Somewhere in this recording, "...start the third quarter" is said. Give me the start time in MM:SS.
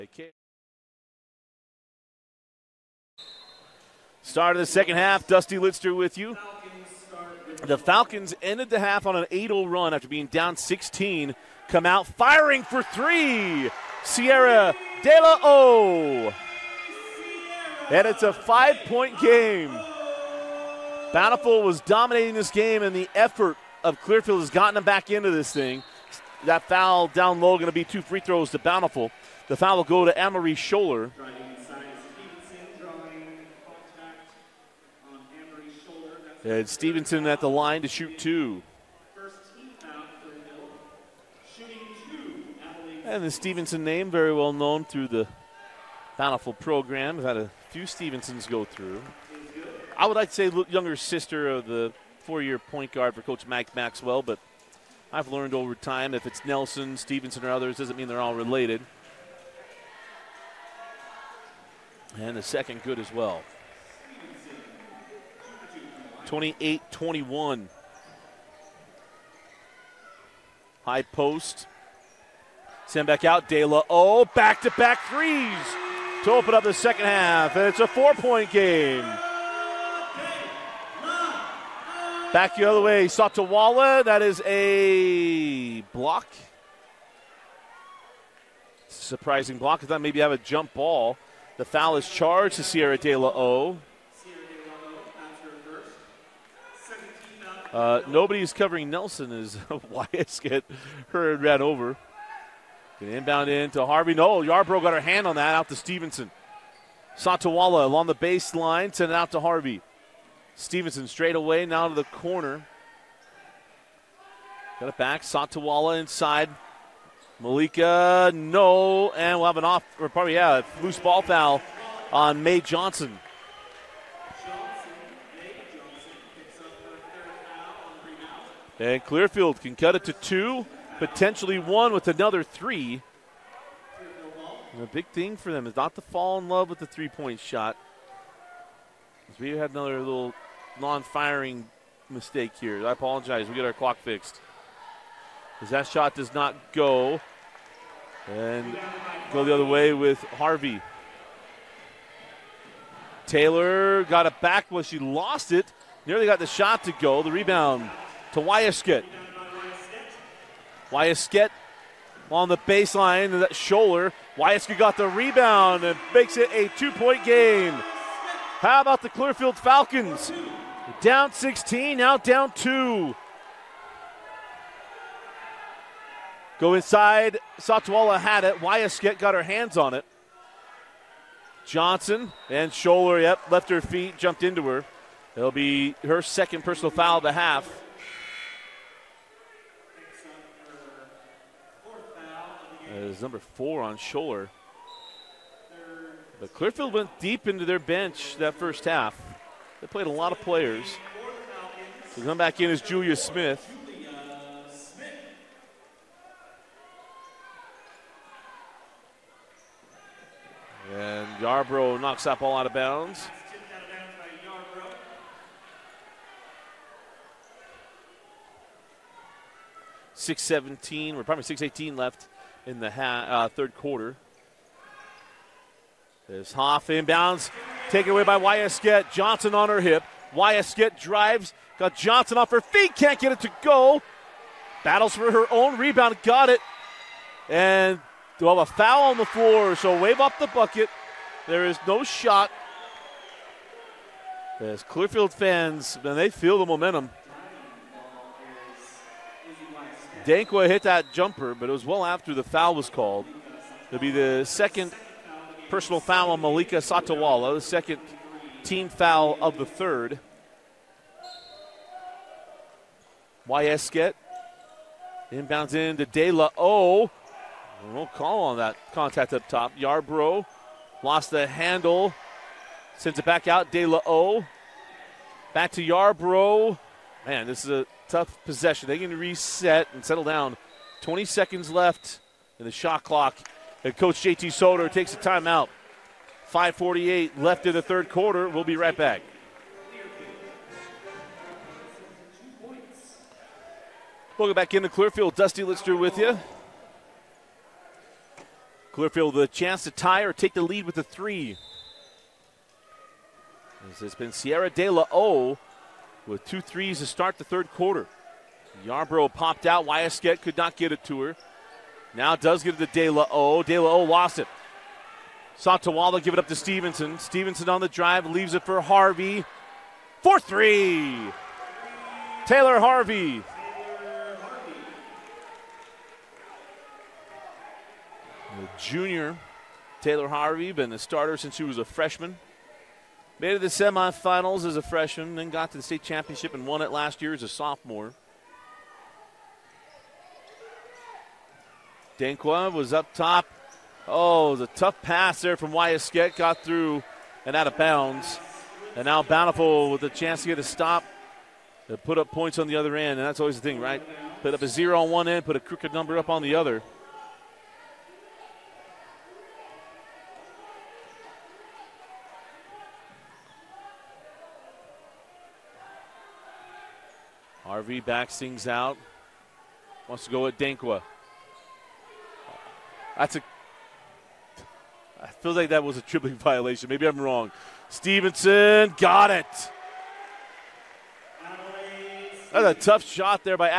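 05:07.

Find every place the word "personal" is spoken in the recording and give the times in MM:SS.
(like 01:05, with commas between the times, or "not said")
03:06, 04:15.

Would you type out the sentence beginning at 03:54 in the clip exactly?
Battles for her own rebound, got it.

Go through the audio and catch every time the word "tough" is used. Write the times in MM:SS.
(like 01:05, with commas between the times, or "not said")
04:38, 05:44, 06:22.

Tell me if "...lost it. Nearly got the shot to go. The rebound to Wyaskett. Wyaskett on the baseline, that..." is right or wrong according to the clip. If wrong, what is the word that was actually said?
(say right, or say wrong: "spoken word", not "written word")
right.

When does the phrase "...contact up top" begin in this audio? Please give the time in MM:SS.
04:28.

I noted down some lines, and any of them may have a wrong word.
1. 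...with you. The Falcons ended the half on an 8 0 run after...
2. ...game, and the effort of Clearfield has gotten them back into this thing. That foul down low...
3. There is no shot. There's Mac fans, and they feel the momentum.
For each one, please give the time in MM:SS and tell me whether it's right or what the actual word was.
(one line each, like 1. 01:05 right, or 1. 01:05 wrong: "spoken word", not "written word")
1. 00:05 right
2. 00:22 right
3. 04:01 wrong: "Clearfield", not "Mac".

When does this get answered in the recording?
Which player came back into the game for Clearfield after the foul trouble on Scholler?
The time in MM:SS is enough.
03:22.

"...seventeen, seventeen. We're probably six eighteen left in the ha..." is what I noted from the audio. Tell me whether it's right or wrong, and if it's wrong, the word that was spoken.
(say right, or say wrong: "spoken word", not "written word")
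right.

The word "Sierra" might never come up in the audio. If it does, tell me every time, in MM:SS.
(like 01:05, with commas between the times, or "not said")
00:14, 01:32, 05:04.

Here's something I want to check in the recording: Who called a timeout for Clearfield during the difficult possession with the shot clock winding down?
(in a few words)
JT Soder.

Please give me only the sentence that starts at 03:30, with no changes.
And Yarbrough knocks that ball out of bounds.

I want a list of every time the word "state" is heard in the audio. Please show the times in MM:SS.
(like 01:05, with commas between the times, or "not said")
05:35.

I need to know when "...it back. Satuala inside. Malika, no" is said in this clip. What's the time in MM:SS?
01:54.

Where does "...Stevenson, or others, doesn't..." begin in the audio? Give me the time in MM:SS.
00:56.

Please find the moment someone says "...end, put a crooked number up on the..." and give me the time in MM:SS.
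05:55.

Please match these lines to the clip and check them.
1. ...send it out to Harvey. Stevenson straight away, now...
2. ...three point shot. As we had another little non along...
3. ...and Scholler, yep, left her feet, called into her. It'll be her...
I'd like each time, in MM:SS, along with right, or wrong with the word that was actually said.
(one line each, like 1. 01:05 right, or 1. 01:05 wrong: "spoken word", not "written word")
1. 01:48 right
2. 02:16 wrong: "firing", not "along"
3. 03:02 wrong: "jumped", not "called".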